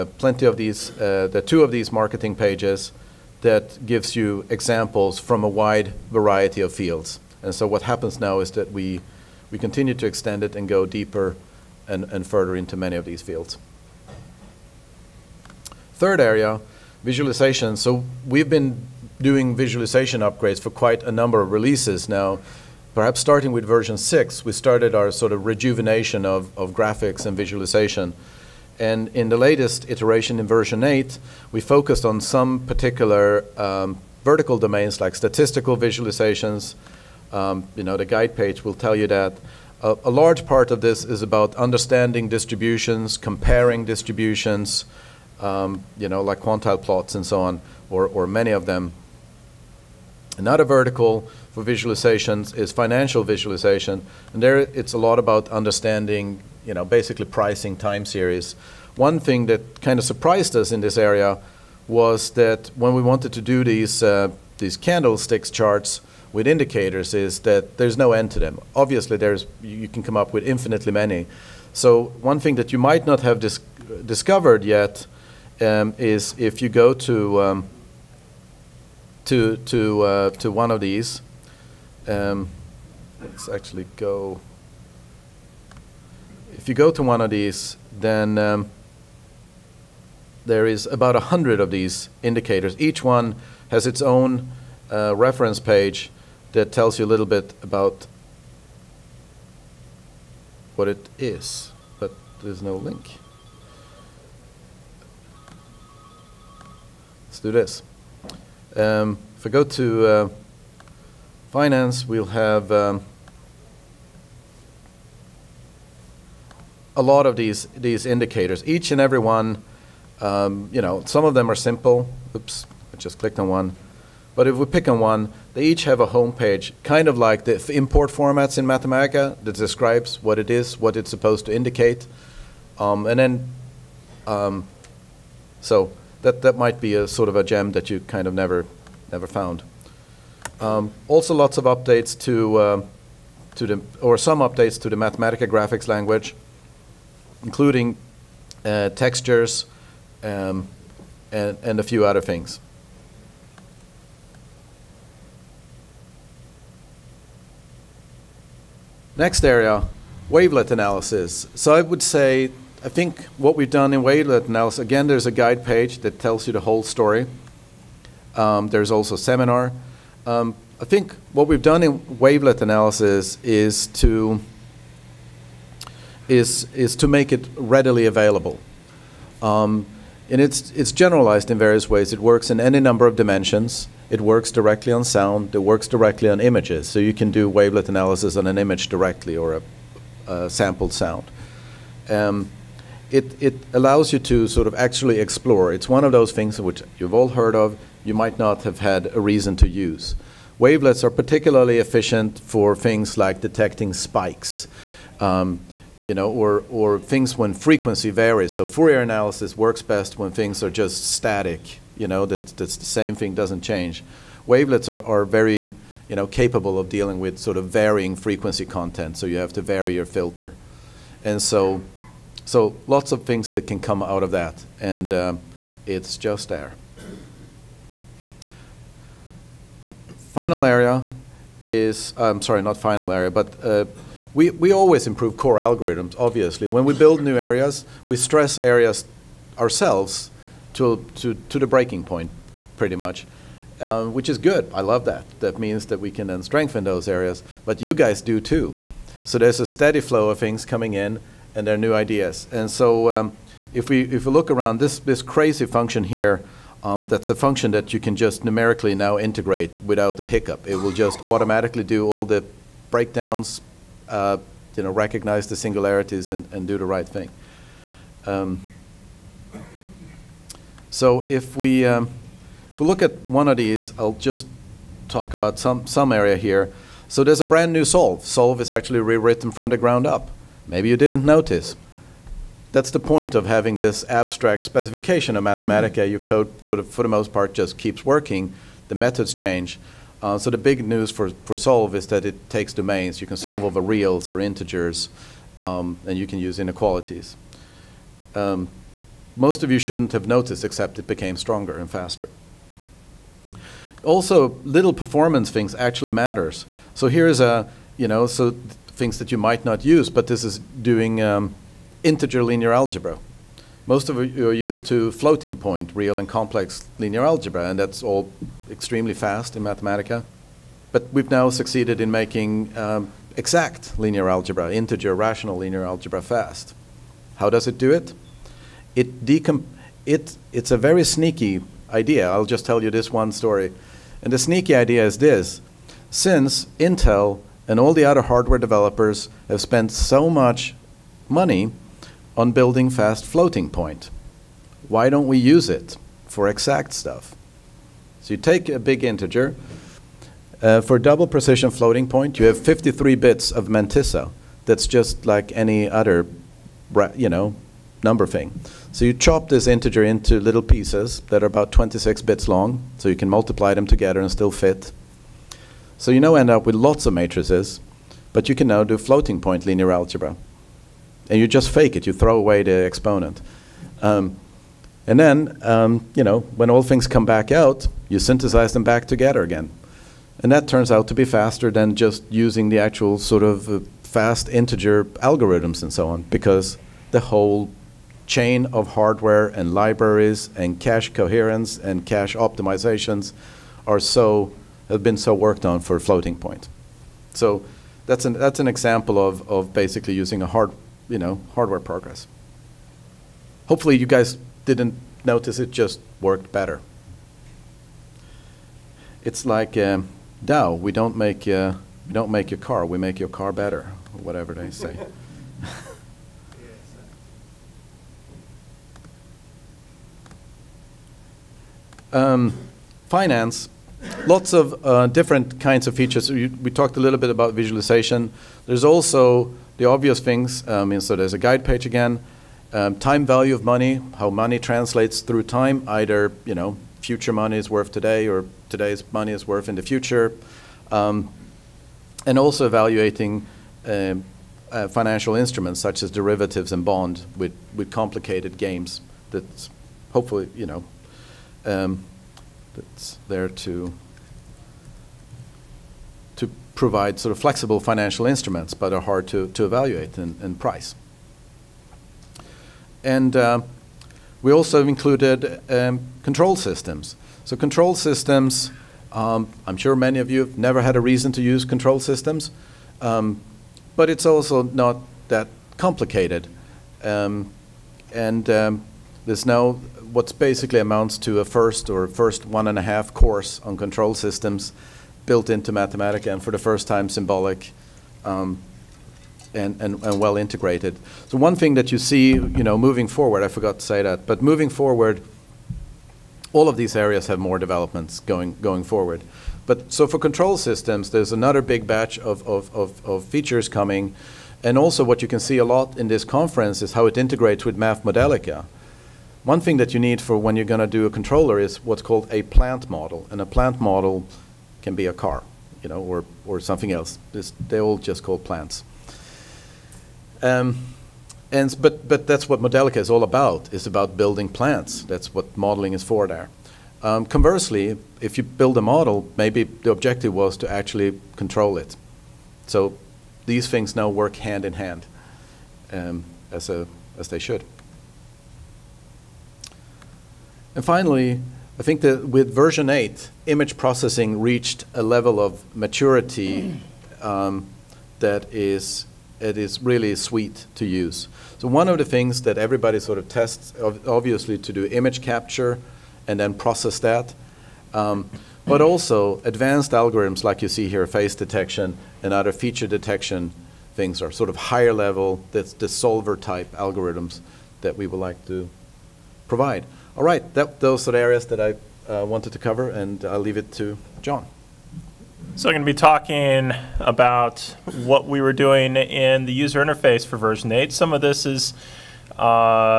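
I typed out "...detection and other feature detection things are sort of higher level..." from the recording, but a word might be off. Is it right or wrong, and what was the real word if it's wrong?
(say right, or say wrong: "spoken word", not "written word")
right.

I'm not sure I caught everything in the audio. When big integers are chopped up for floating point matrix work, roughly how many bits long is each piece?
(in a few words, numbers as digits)
26 bits.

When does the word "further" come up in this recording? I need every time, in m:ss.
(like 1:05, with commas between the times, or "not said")
0:12.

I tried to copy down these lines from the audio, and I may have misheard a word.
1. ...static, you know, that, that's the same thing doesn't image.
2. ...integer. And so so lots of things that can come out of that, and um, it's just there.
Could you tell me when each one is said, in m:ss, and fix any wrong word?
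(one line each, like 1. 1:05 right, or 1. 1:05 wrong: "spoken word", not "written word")
1. 3:31 wrong: "change", not "image"
2. 3:40 wrong: "filter", not "integer".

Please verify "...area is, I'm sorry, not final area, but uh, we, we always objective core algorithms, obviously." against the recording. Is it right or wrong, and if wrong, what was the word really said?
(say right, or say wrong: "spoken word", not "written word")
wrong: "improve", not "objective".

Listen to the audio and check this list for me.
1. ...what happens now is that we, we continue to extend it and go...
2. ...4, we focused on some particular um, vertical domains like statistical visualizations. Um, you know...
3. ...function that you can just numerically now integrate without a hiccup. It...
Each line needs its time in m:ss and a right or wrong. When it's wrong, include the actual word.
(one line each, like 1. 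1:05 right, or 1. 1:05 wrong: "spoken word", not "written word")
1. 0:07 right
2. 0:30 wrong: "8", not "4"
3. 4:17 right.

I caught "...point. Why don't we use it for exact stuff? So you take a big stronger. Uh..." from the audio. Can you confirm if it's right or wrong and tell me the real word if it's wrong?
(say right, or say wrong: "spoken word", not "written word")
wrong: "integer", not "stronger".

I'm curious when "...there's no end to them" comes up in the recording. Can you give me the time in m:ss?
1:07.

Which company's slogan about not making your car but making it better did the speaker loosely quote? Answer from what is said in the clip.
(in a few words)
Dow.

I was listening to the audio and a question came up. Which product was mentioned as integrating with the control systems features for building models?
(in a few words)
MathModelica.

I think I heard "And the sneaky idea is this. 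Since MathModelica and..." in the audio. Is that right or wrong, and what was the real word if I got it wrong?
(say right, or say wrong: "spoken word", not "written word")
wrong: "Intel", not "MathModelica".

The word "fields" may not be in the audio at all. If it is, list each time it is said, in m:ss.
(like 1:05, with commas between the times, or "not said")
0:06, 0:13.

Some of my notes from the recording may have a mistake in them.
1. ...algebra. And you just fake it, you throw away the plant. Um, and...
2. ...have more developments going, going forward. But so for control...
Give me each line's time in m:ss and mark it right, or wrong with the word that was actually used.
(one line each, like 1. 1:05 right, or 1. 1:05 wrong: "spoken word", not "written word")
1. 6:09 wrong: "exponent", not "plant"
2. 8:17 right.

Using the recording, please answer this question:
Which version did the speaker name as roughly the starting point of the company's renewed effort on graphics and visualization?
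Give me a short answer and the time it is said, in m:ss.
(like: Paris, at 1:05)
version 6, at 0:23.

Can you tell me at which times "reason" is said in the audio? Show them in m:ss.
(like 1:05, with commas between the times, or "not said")
3:19, 7:51.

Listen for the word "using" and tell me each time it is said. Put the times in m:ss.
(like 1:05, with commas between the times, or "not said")
6:22, 6:40.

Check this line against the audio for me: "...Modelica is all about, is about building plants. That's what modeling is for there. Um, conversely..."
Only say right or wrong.
right.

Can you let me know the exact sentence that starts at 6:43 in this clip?
Hopefully you guys didn't notice it just worked better.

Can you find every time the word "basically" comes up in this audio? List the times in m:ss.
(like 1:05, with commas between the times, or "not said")
0:56, 6:39, 8:00.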